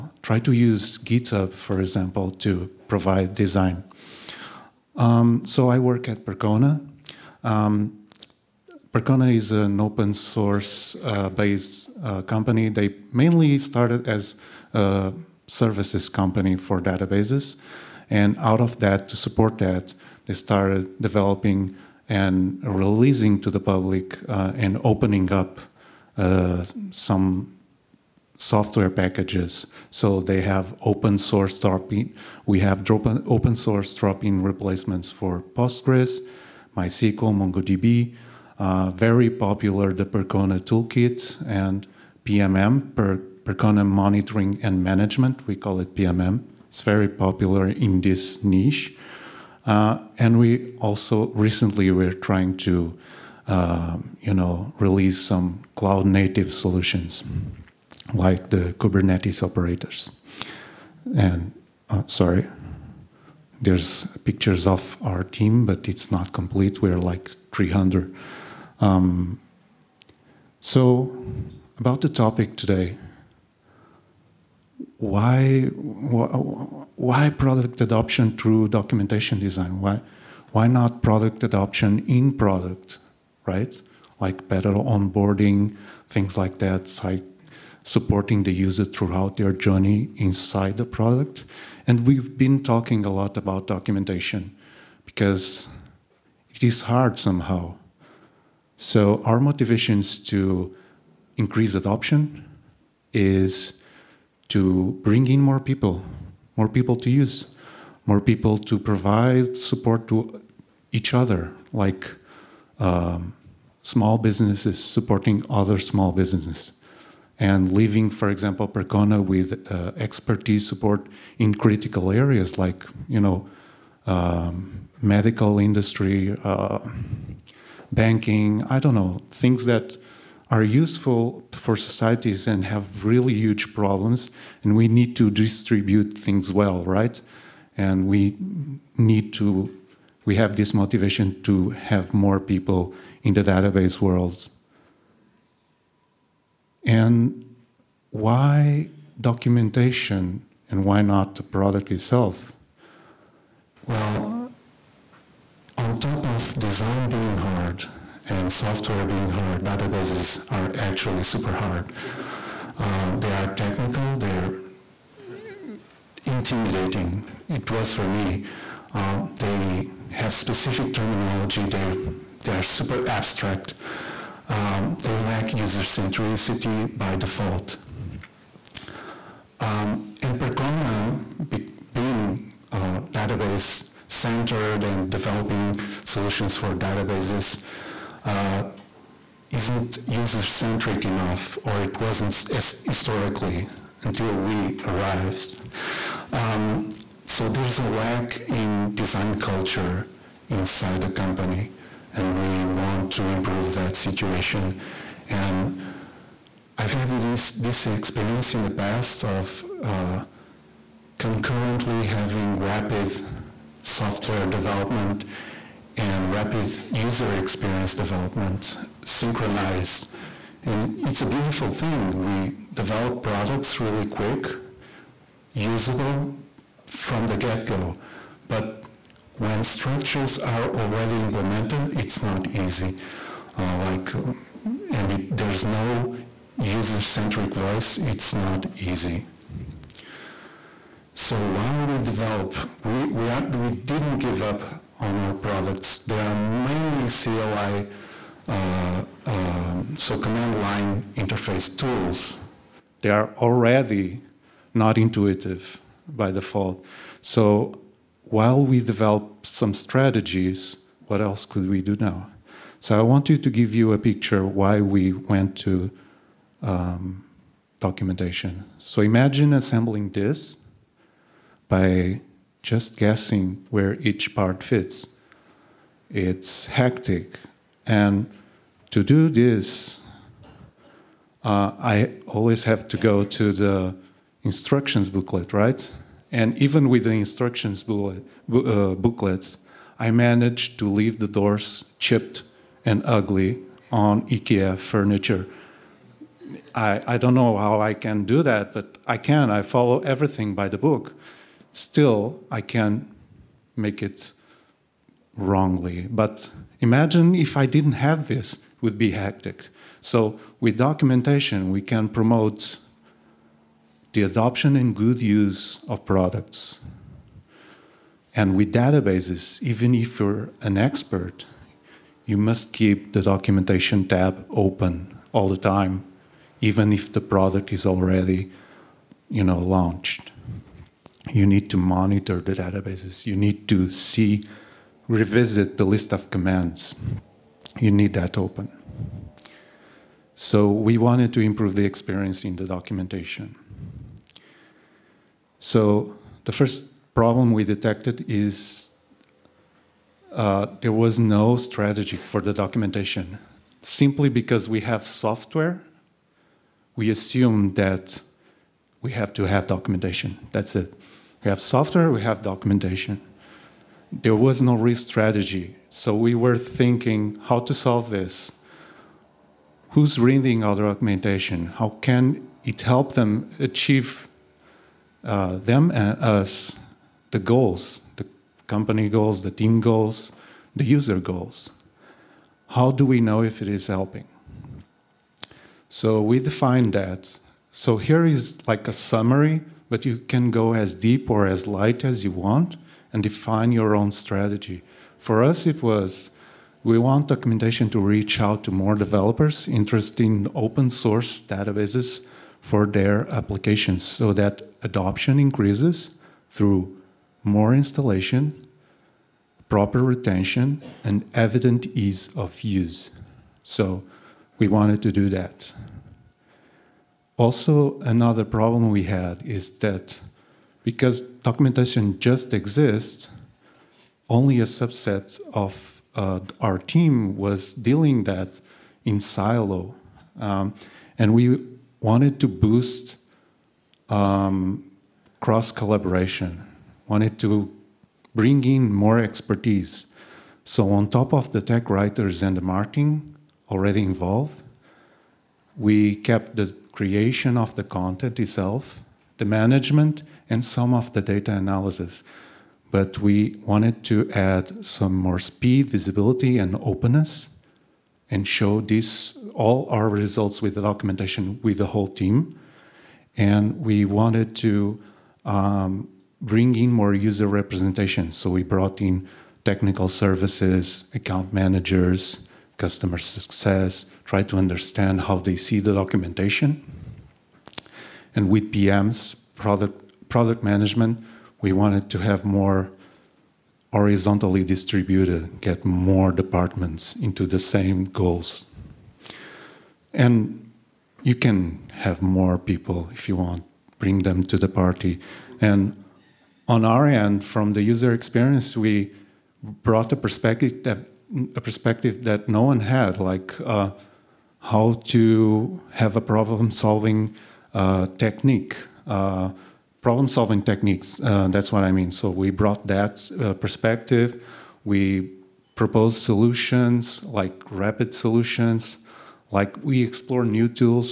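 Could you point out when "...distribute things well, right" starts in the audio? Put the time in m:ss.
2:15.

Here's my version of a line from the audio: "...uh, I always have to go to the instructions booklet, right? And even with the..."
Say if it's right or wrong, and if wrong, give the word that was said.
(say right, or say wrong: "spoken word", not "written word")
right.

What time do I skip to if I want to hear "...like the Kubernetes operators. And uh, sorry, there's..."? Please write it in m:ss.
0:58.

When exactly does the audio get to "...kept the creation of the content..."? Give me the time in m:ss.
7:26.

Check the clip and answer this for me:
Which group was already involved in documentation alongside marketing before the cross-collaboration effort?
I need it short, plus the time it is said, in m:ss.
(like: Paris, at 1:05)
tech writers, at 7:21.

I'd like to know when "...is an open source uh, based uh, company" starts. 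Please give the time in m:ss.
0:09.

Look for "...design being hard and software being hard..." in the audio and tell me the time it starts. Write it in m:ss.
2:36.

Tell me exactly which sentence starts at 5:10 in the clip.
So with documentation, we can promote the adoption and good use of products.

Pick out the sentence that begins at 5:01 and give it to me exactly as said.
Still, I can make it wrongly.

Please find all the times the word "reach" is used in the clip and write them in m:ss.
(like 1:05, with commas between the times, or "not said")
6:38.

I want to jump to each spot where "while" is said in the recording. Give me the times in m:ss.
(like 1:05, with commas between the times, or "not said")
4:01, 4:18.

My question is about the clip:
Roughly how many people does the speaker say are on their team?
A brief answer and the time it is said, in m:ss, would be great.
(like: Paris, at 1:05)
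300, at 1:06.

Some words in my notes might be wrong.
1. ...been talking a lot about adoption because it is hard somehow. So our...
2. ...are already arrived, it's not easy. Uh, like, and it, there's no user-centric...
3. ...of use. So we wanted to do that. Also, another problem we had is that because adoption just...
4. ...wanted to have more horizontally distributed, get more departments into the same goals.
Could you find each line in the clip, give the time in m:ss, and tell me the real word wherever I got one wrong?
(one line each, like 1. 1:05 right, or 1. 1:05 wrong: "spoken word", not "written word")
1. 1:32 wrong: "documentation", not "adoption"
2. 3:50 wrong: "implemented", not "arrived"
3. 6:52 wrong: "documentation", not "adoption"
4. 8:01 right.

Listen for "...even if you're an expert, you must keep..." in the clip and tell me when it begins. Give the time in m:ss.
5:19.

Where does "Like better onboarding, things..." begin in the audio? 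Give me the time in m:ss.
1:24.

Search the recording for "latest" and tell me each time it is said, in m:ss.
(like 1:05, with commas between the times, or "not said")
not said.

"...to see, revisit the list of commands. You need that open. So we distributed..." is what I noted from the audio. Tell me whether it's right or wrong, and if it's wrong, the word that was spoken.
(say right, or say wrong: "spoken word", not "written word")
wrong: "wanted", not "distributed".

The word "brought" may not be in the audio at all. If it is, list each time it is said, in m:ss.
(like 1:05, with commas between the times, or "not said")
7:48, 8:19, 8:32.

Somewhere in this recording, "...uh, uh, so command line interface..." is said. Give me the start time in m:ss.
4:08.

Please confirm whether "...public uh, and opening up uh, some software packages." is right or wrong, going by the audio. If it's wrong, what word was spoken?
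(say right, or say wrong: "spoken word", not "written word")
right.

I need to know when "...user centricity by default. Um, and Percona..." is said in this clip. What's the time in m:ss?
2:55.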